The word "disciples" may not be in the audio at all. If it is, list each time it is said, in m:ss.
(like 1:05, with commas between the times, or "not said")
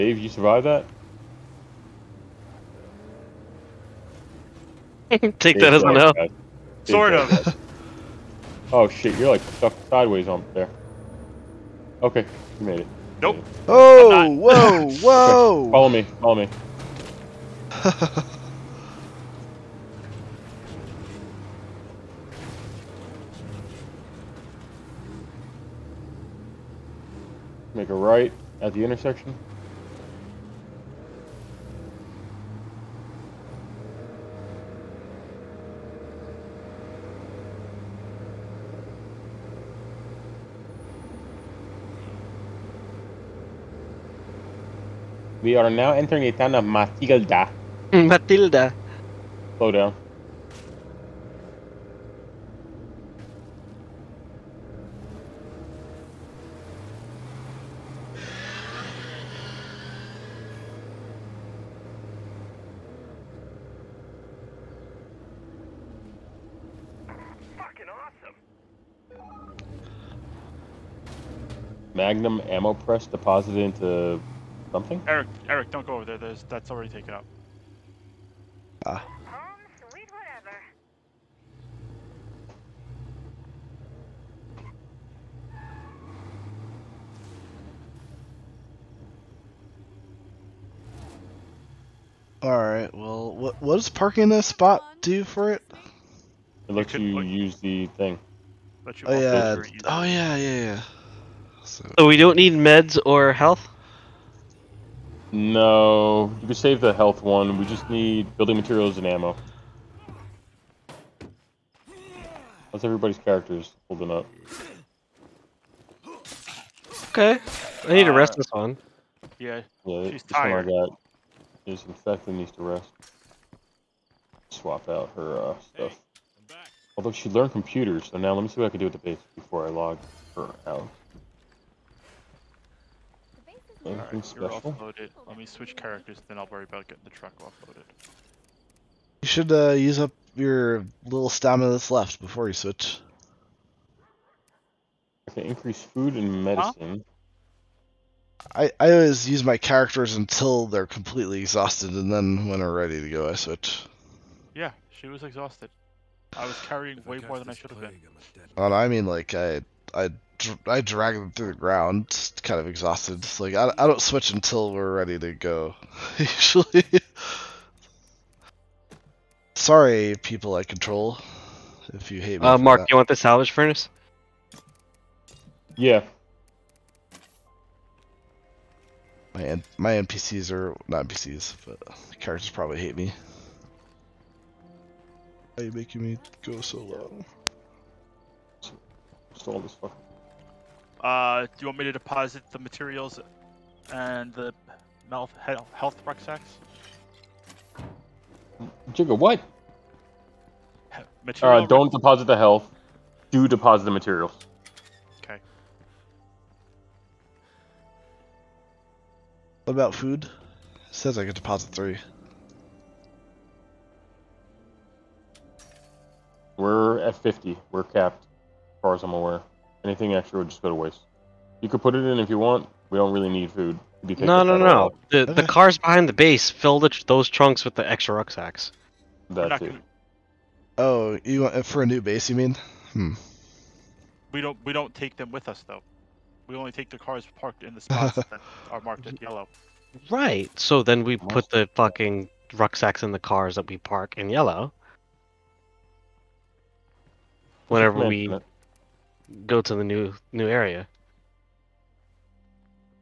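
not said.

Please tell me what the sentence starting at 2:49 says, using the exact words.
Sorry, people I control, if you hate me.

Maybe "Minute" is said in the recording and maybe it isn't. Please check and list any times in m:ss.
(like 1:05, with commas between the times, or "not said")
4:08.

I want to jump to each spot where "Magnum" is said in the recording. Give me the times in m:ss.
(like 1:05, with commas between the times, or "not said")
1:11.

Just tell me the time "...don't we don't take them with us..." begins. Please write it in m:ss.
3:54.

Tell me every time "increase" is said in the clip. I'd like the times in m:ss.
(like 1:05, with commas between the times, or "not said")
2:25.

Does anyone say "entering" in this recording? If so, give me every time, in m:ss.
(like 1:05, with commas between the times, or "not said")
0:45.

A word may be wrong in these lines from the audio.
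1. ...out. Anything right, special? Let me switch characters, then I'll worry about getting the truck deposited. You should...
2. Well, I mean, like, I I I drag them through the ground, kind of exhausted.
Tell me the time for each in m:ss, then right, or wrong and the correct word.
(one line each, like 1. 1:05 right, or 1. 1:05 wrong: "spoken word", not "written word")
1. 2:10 wrong: "offloaded", not "deposited"
2. 2:38 right.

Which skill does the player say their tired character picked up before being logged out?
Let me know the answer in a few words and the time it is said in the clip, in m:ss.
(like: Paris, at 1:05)
Computers, at 2:07.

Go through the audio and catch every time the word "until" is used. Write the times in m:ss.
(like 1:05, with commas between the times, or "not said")
2:30, 2:44.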